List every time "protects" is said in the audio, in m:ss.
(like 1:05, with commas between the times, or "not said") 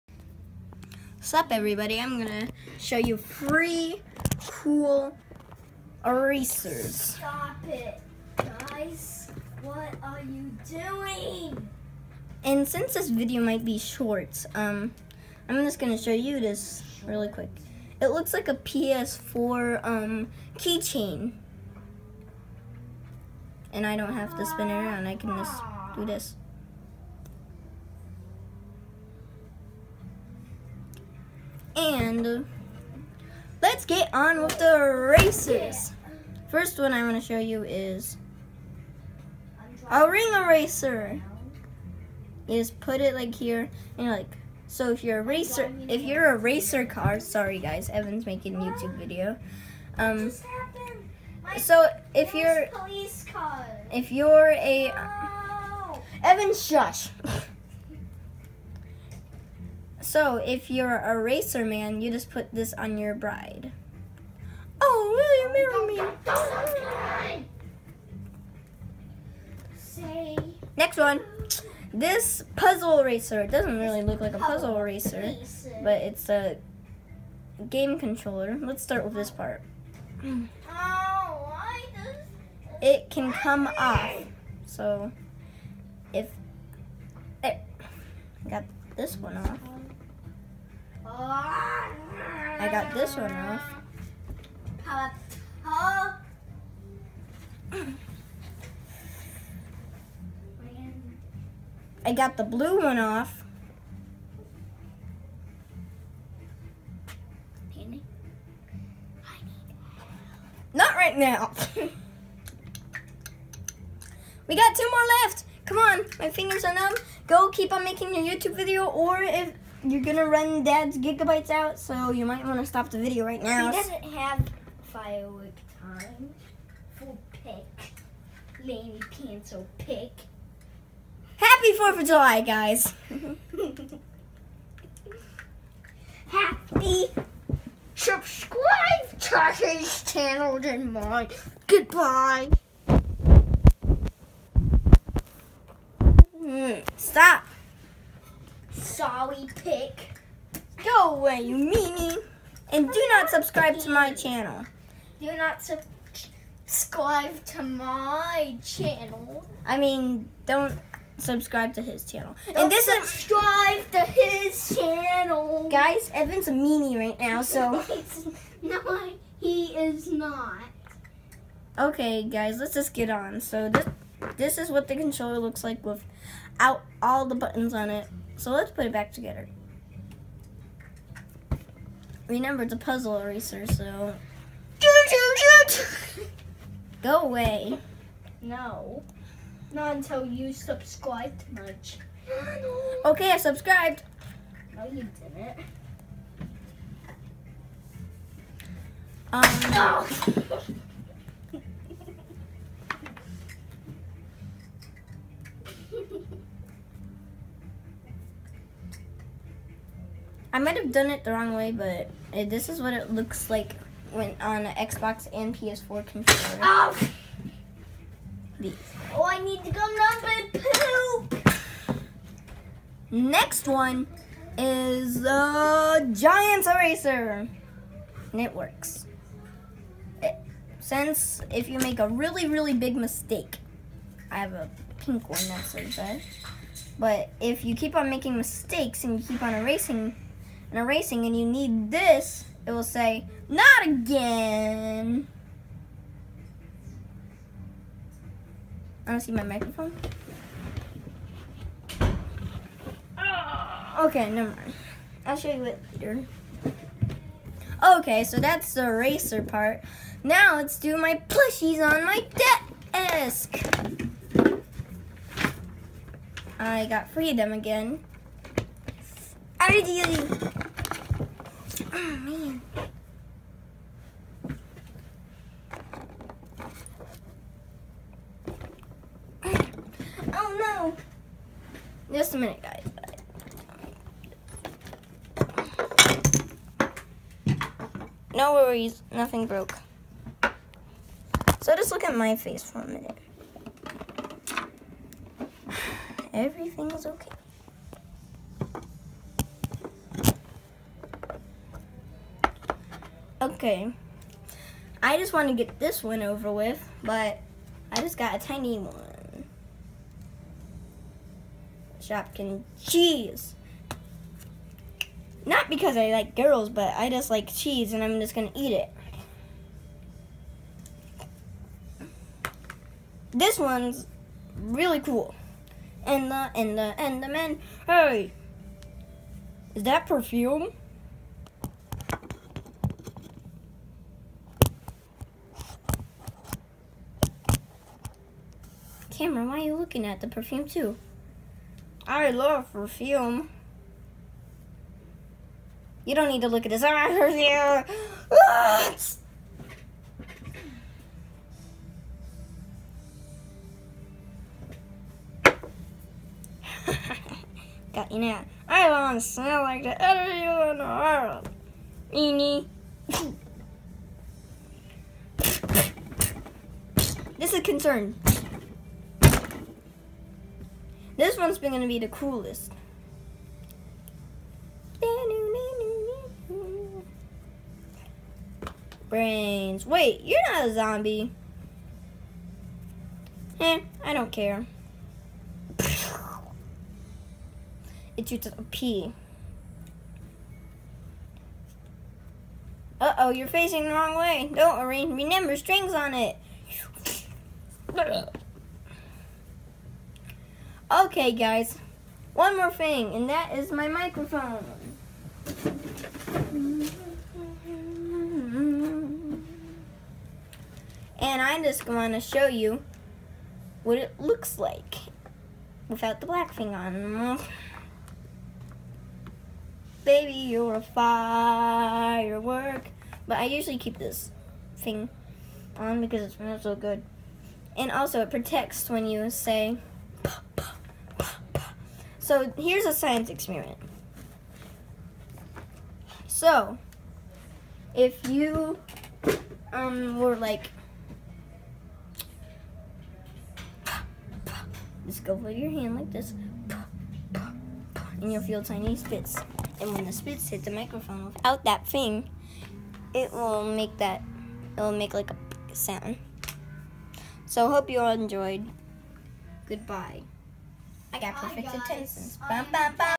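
7:08.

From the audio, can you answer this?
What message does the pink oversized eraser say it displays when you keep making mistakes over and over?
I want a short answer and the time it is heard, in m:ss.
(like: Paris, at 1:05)
not again, at 4:03.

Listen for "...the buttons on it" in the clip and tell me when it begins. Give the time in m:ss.
2:57.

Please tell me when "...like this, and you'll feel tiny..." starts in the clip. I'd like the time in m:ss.
7:25.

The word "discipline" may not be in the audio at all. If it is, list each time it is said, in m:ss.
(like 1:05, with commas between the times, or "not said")
not said.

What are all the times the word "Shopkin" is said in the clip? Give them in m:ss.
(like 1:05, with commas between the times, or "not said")
5:12.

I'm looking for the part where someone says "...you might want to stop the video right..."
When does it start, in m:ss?
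2:02.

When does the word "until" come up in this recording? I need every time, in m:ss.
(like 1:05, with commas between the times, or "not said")
3:09.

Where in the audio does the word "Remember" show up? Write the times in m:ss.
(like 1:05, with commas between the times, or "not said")
3:02, 6:35.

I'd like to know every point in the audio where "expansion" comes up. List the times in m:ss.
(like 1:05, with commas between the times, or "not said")
not said.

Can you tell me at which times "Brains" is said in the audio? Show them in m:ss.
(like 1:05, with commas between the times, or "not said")
6:19.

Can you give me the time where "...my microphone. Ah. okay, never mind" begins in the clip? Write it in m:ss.
4:09.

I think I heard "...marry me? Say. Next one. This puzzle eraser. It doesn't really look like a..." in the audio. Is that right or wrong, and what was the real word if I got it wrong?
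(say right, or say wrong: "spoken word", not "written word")
wrong: "racer", not "eraser".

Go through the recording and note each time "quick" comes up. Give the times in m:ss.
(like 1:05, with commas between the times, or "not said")
0:17.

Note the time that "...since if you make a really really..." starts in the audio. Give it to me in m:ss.
3:50.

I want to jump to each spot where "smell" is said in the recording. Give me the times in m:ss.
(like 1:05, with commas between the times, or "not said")
5:59, 7:06.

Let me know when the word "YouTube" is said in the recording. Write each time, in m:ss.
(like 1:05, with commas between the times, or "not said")
0:48, 1:58.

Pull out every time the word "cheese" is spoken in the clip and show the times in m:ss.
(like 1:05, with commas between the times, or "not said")
5:12, 5:17.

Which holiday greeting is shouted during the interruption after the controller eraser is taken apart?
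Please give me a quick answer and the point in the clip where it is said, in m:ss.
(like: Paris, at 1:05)
Happy 4th of July, at 2:11.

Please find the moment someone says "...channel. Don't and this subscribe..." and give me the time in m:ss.
2:42.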